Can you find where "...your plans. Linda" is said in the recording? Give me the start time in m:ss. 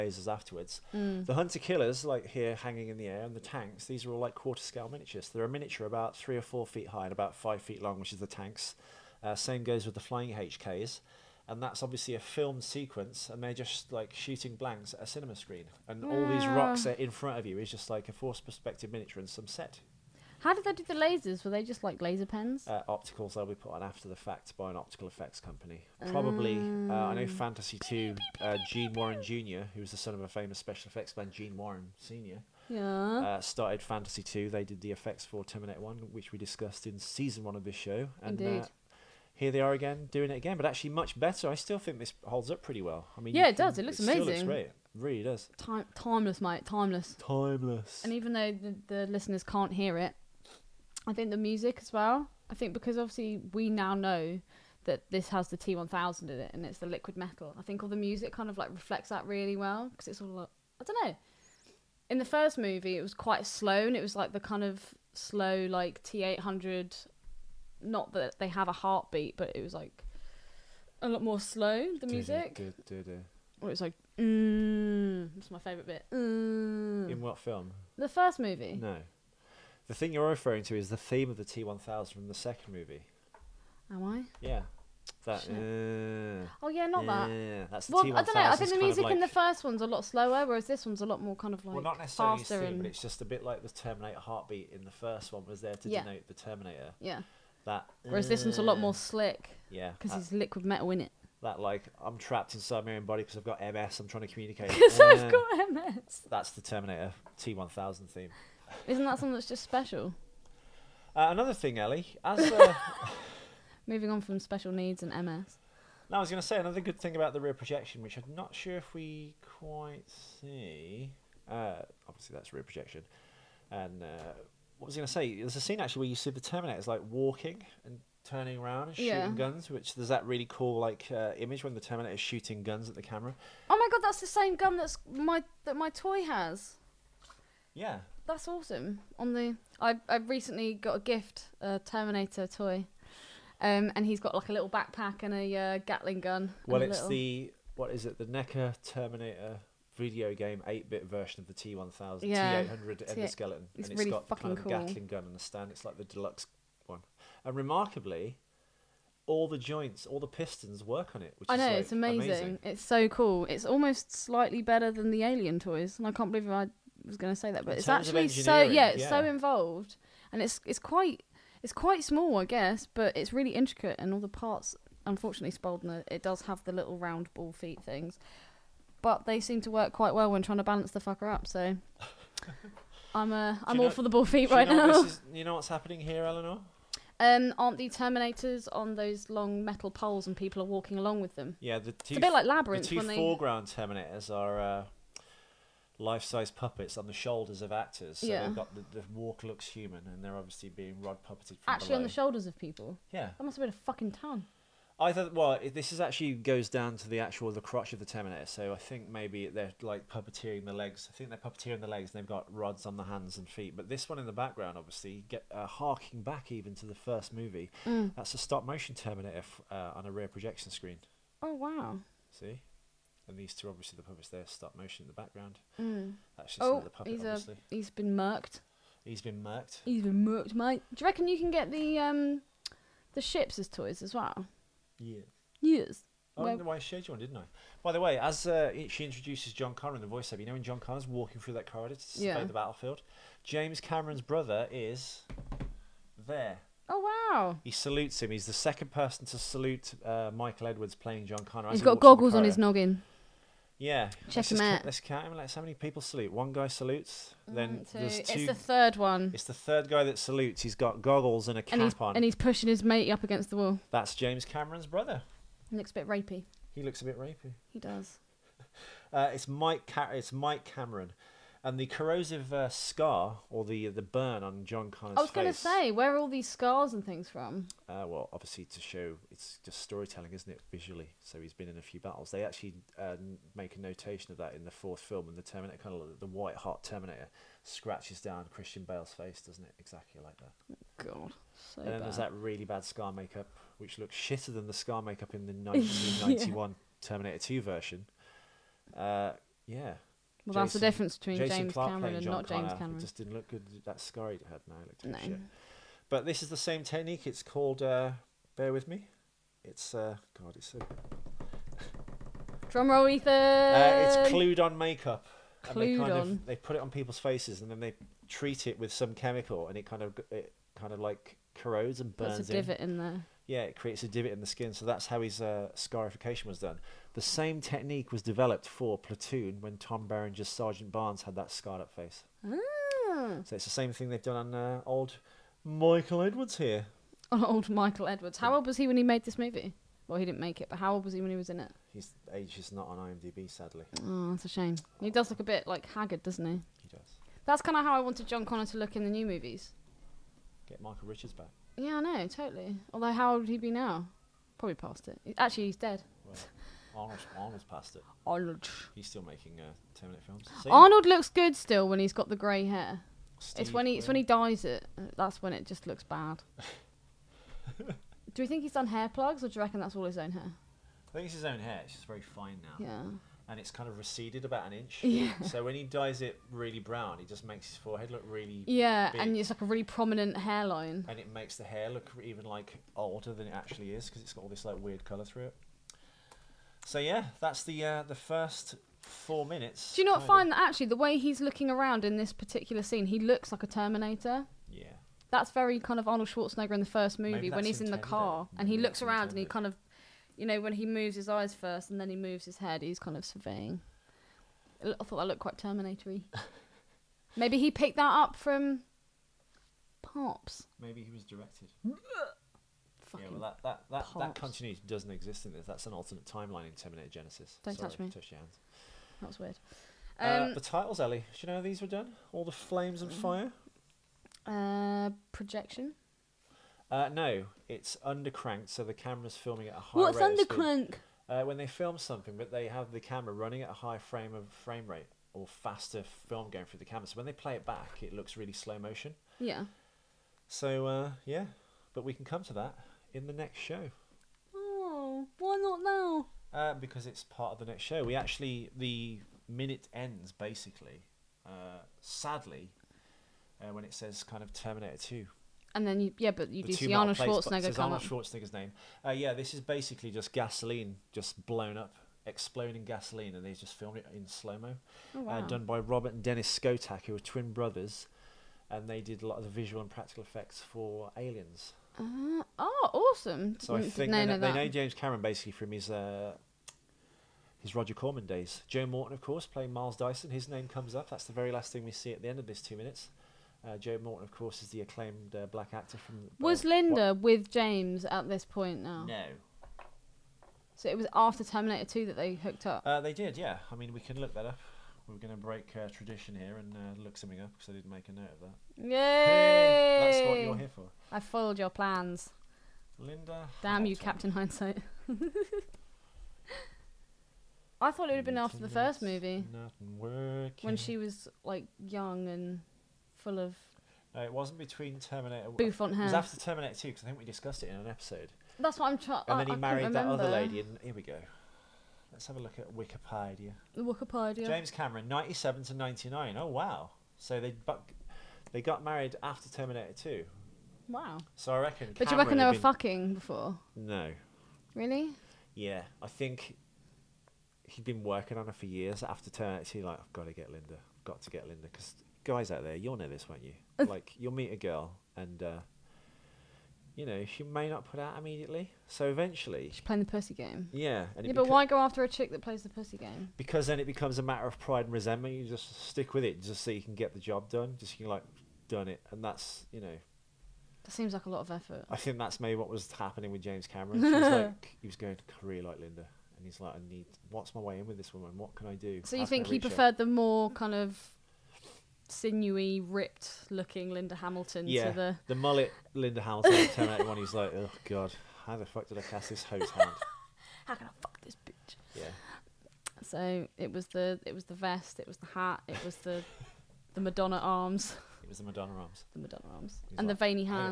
8:21.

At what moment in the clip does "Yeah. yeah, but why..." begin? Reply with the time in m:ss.
9:10.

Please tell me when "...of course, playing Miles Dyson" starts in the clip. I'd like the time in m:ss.
7:59.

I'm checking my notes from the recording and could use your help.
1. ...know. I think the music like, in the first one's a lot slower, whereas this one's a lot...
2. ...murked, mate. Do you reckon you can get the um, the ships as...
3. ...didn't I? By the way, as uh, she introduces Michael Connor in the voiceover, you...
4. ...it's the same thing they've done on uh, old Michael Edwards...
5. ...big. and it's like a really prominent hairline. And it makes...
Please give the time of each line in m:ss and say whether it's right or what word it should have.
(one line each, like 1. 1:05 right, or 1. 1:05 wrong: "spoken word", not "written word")
1. 1:28 right
2. 3:50 right
3. 3:57 wrong: "John", not "Michael"
4. 5:33 right
5. 6:19 right.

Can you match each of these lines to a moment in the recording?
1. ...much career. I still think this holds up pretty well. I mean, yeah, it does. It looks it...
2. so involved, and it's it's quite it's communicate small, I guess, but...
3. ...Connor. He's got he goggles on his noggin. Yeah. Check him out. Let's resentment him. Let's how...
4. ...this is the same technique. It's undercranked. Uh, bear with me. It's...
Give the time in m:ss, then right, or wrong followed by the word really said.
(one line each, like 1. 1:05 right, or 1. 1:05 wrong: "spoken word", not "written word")
1. 0:40 wrong: "better", not "career"
2. 2:49 wrong: "quite", not "communicate"
3. 4:11 wrong: "count", not "resentment"
4. 5:06 wrong: "called", not "undercranked".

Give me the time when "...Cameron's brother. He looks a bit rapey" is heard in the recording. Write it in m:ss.
4:24.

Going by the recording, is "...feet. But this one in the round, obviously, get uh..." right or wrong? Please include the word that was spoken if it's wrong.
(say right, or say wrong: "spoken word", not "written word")
wrong: "background", not "round".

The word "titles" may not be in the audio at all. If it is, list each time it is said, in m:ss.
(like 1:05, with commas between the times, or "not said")
7:00.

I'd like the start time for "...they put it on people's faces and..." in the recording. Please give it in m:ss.
5:16.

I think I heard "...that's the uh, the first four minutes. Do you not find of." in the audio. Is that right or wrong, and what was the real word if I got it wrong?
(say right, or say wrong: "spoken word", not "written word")
right.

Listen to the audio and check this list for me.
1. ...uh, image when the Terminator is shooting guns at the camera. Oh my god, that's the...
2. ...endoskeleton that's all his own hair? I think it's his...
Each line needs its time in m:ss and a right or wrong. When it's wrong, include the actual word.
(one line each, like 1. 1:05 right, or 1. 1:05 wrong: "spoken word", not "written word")
1. 2:11 right
2. 6:09 wrong: "reckon", not "endoskeleton".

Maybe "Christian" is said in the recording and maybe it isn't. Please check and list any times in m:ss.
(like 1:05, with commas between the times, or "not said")
4:48.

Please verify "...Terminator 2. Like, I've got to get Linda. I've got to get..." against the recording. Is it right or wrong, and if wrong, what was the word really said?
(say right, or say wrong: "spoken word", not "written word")
right.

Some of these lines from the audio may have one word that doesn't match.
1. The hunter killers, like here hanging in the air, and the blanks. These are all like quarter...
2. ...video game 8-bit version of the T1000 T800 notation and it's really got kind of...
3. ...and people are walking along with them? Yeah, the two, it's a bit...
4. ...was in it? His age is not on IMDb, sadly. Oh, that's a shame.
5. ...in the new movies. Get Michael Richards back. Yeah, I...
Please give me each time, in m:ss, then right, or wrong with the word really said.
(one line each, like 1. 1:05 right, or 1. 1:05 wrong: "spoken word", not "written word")
1. 0:01 wrong: "tanks", not "blanks"
2. 2:29 wrong: "endoskeleton", not "notation"
3. 3:10 right
4. 5:41 right
5. 5:48 right.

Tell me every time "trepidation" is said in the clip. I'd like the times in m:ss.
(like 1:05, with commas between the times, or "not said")
not said.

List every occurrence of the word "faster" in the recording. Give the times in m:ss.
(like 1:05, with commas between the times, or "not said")
1:32, 7:15.